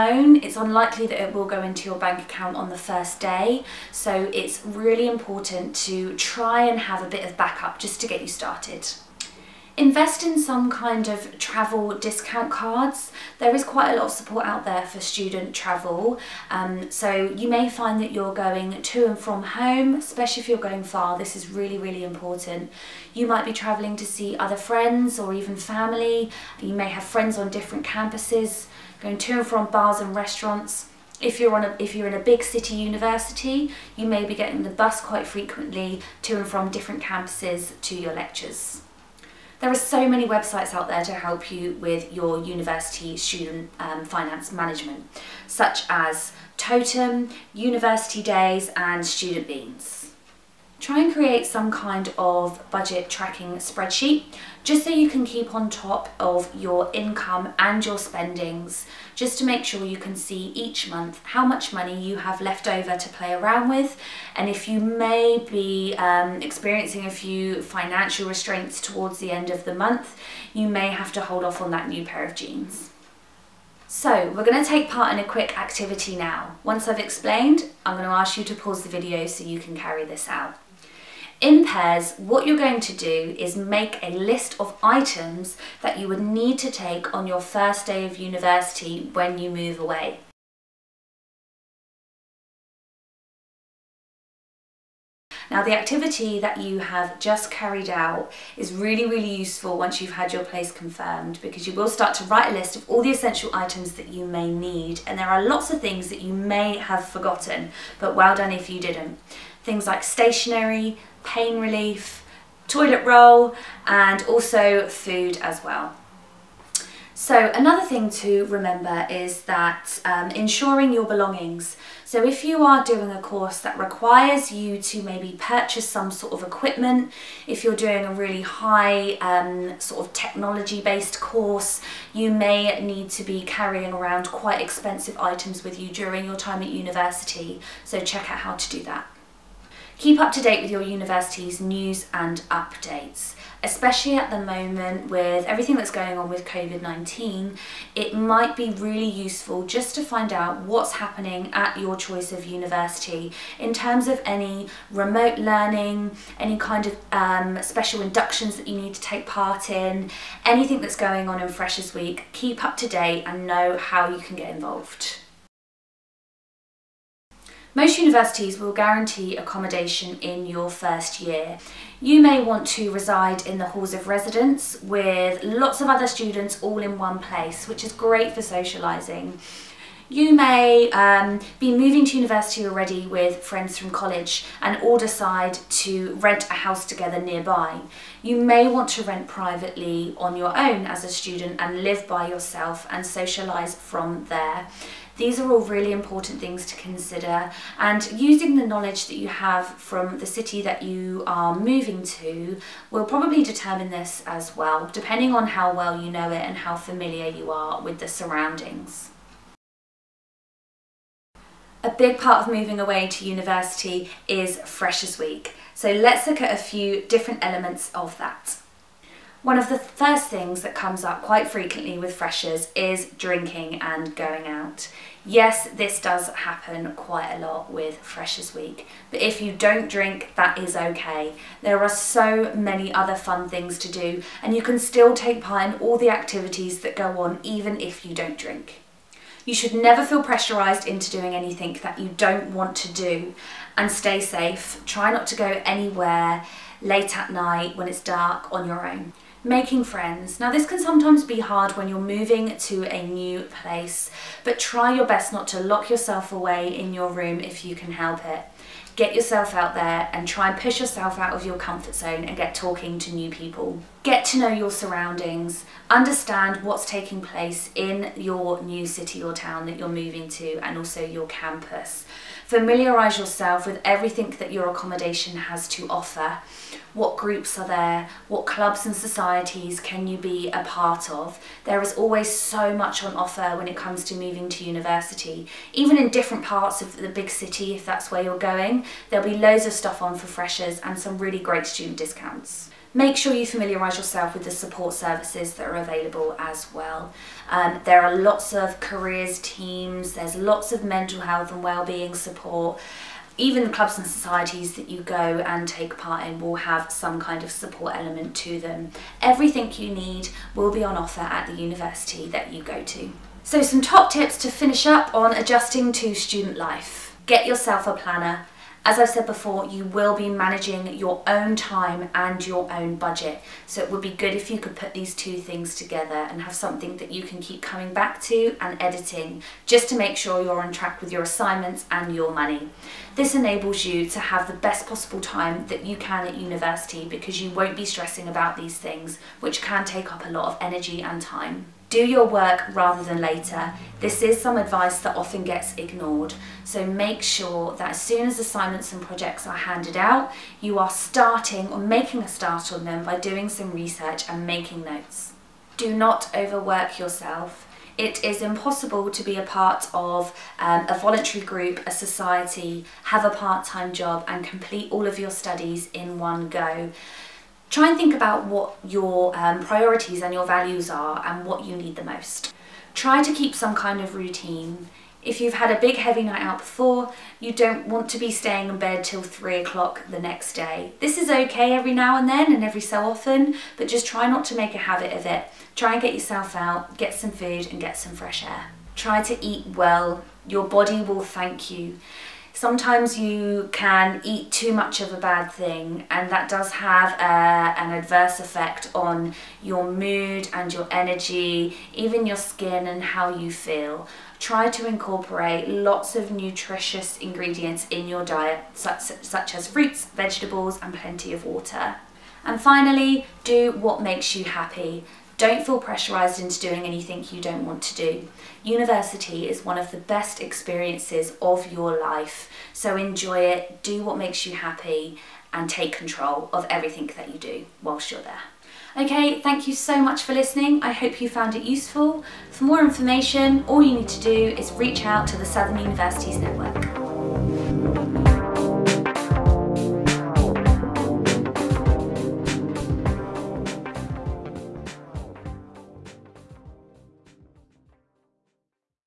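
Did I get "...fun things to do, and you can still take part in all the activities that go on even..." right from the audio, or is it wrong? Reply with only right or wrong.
right.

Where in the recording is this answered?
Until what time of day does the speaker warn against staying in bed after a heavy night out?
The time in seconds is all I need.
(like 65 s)
379 s.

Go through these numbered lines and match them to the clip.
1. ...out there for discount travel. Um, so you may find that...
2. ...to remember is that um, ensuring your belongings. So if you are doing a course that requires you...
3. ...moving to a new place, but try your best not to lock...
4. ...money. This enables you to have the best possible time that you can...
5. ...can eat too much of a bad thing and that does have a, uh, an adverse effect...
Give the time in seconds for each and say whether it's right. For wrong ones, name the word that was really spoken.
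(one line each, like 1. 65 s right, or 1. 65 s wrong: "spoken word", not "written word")
1. 14 s wrong: "student", not "discount"
2. 118 s right
3. 251 s right
4. 332 s right
5. 393 s right.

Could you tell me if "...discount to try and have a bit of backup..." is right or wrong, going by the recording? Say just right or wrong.
wrong.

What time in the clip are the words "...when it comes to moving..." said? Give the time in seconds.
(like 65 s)
283 s.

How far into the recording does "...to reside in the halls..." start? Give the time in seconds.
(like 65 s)
172 s.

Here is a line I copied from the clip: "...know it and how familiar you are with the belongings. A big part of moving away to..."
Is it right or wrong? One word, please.
wrong.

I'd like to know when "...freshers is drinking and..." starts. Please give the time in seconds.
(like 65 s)
222 s.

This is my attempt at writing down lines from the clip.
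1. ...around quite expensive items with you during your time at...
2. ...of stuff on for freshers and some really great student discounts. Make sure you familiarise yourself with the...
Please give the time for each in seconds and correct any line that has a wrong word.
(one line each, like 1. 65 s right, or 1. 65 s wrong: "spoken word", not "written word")
1. 133 s right
2. 289 s right.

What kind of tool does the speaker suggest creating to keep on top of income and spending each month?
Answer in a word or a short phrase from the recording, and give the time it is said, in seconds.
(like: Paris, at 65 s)
Budget tracking spreadsheet, at 52 s.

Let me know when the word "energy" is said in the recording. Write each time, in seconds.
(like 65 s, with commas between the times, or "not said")
340 s, 400 s.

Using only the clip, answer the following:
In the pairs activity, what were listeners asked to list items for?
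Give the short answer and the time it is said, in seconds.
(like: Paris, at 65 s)
First day of university, at 87 s.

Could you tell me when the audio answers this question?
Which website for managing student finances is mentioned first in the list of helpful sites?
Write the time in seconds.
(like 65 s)
46 s.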